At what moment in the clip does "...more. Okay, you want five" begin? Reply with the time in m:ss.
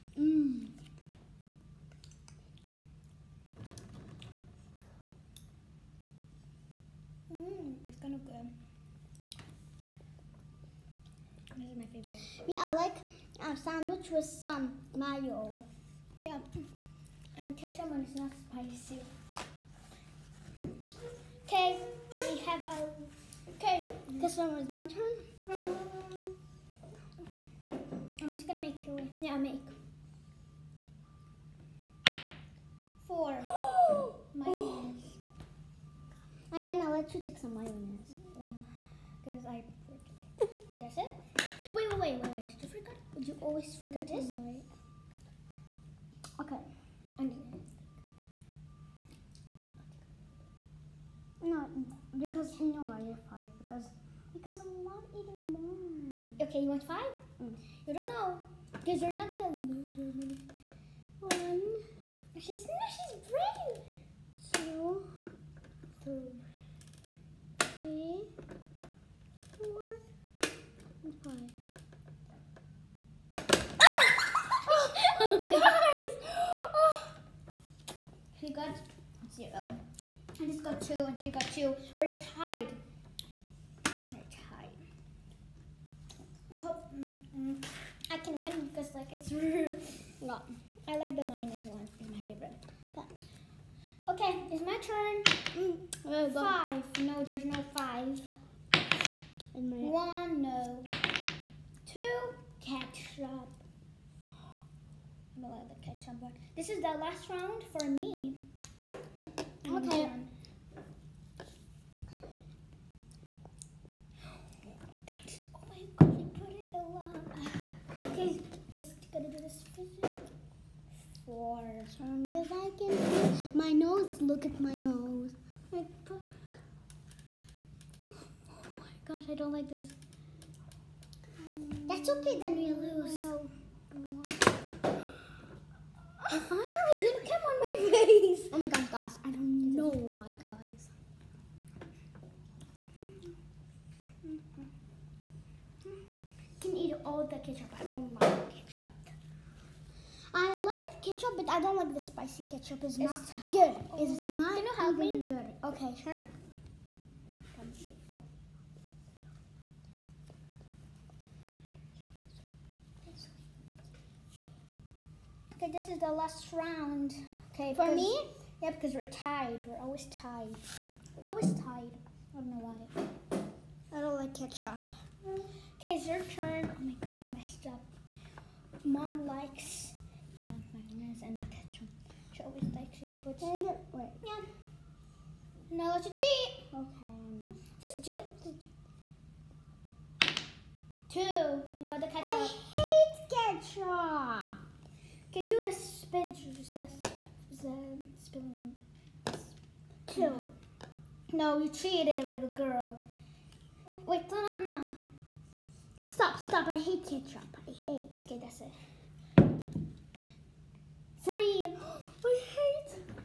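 0:55.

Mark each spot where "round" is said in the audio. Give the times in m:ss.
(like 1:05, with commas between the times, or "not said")
1:47, 2:46.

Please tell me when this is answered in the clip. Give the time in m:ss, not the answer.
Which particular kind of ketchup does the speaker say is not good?
2:31.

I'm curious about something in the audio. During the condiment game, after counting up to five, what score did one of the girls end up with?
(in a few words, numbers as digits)
0.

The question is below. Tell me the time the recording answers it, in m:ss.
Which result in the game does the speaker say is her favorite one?
1:31.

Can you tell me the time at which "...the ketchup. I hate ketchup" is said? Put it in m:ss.
3:11.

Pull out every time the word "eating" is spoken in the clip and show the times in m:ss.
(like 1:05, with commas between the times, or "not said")
0:55.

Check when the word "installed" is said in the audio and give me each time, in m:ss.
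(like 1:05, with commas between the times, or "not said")
not said.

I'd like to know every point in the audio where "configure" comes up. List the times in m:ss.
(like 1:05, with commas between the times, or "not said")
not said.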